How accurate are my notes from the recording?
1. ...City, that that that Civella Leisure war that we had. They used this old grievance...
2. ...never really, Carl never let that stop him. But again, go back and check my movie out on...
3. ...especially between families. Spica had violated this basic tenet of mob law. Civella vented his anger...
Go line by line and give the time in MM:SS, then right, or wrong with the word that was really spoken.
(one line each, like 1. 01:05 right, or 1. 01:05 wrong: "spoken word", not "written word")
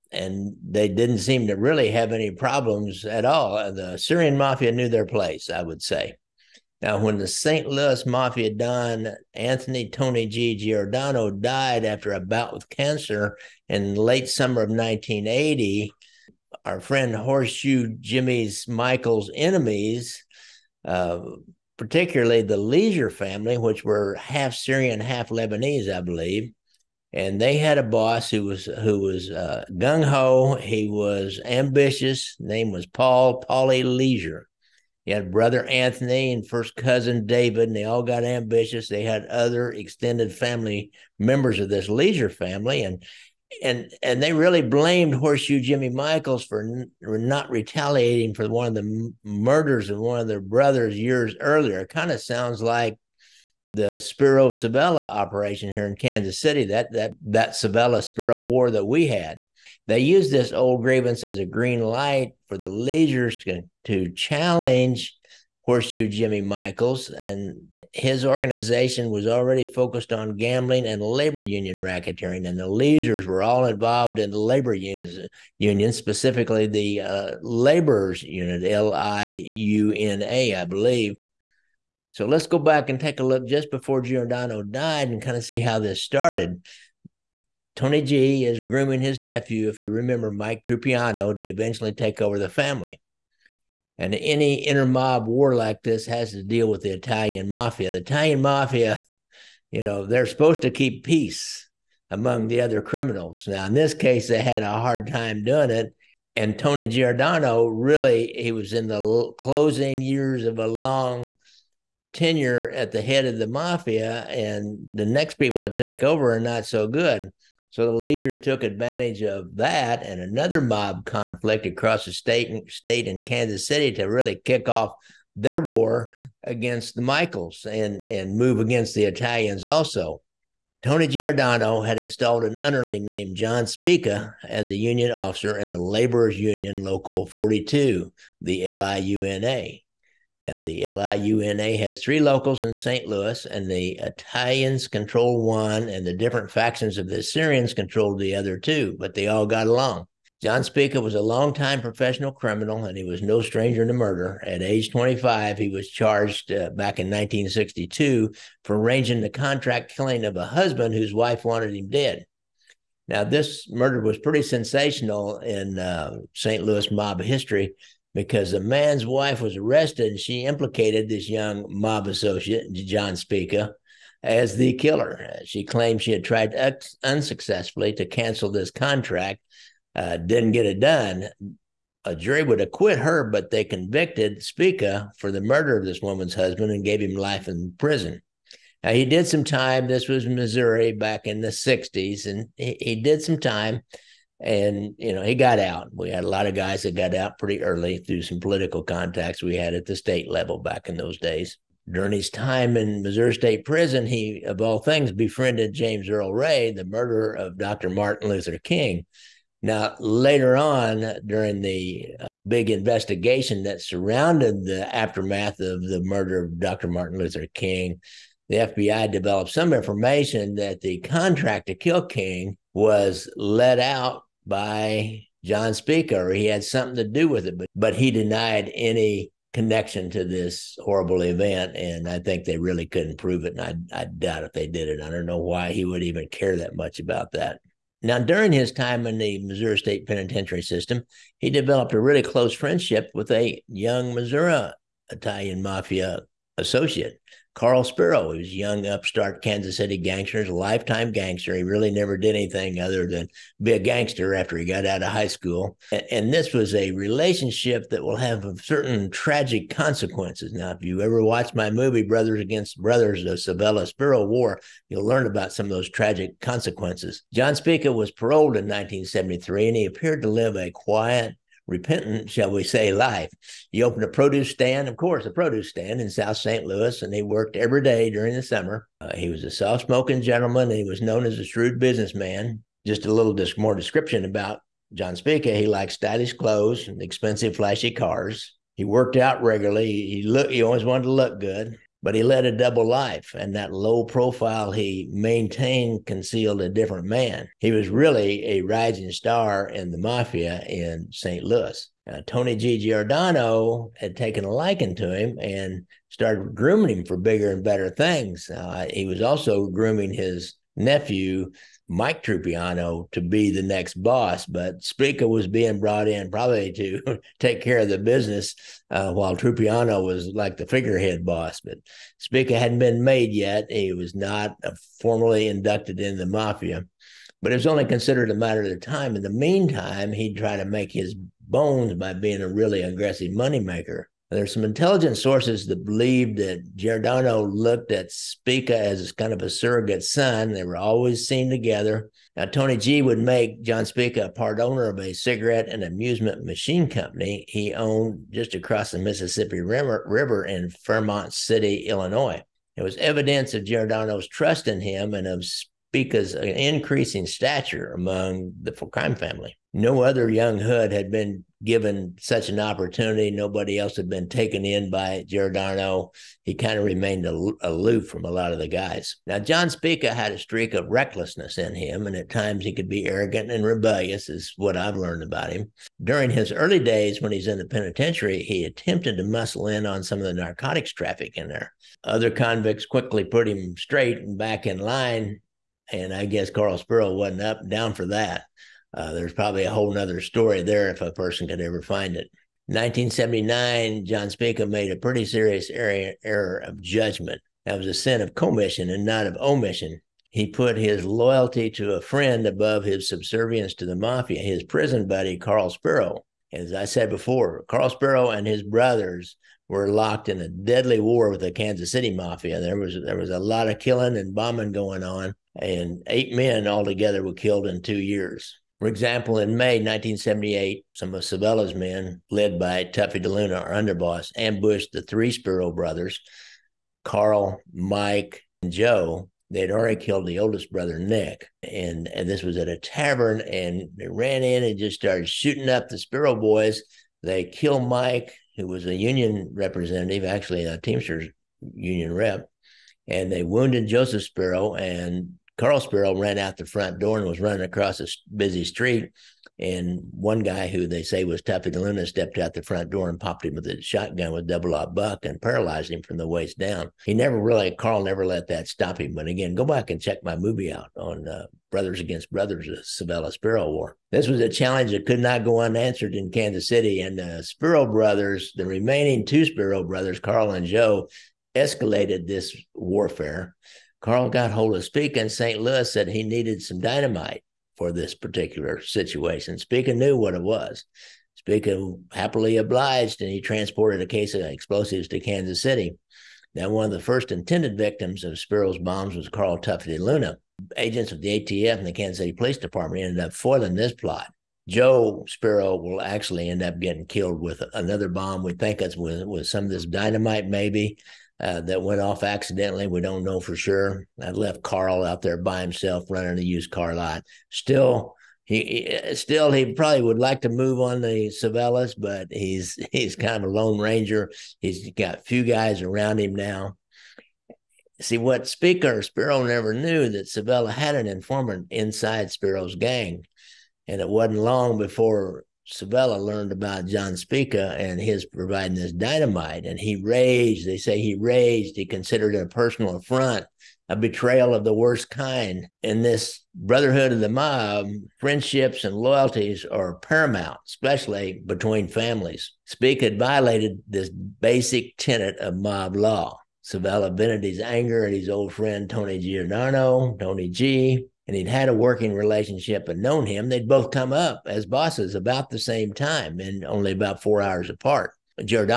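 1. 00:56 wrong: "Spero", not "Leisure"
2. 07:37 right
3. 09:00 right.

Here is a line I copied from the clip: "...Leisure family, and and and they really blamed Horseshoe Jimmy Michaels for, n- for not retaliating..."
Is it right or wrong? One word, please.
right.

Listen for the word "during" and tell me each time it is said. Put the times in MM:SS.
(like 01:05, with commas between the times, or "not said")
03:21, 03:31, 03:58, 04:38, 06:16.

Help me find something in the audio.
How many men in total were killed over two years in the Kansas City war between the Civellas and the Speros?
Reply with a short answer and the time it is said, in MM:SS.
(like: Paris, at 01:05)
8, at 06:56.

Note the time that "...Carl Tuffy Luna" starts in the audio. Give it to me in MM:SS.
08:09.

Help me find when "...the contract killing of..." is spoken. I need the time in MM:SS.
02:39.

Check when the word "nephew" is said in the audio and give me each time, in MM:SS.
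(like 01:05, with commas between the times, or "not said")
01:29, 05:10.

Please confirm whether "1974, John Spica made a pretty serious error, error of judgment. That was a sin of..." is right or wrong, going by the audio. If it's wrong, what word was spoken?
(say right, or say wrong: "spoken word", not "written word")
wrong: "1979", not "1974".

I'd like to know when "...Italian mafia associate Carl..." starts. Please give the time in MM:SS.
04:05.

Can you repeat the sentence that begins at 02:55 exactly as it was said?
She claimed she had tried unsuccessfully to cancel this contract, uh, didn't get it done.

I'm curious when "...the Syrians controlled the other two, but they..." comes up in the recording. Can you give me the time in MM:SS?
02:27.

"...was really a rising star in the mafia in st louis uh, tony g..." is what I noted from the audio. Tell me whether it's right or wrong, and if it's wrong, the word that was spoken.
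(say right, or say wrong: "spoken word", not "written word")
right.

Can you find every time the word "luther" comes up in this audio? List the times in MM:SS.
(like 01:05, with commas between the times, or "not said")
03:28, 03:37.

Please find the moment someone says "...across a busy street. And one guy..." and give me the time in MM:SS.
07:27.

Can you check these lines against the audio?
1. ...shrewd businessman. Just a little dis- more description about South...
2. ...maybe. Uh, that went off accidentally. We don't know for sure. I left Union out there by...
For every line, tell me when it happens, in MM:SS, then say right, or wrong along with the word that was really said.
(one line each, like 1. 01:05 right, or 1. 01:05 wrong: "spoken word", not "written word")
1. 04:41 wrong: "John", not "South"
2. 08:20 wrong: "Carl", not "Union".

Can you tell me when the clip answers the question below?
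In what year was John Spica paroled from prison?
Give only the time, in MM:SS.
04:28.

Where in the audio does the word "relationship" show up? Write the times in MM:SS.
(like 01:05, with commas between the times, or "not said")
04:16, 09:12.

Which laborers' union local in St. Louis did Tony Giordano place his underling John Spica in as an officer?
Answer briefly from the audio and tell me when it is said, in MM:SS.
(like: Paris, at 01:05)
Local 42, at 02:16.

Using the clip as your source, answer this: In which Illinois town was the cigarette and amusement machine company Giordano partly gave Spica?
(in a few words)
Fairmont City.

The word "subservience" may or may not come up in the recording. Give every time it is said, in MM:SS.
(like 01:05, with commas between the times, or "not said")
06:43.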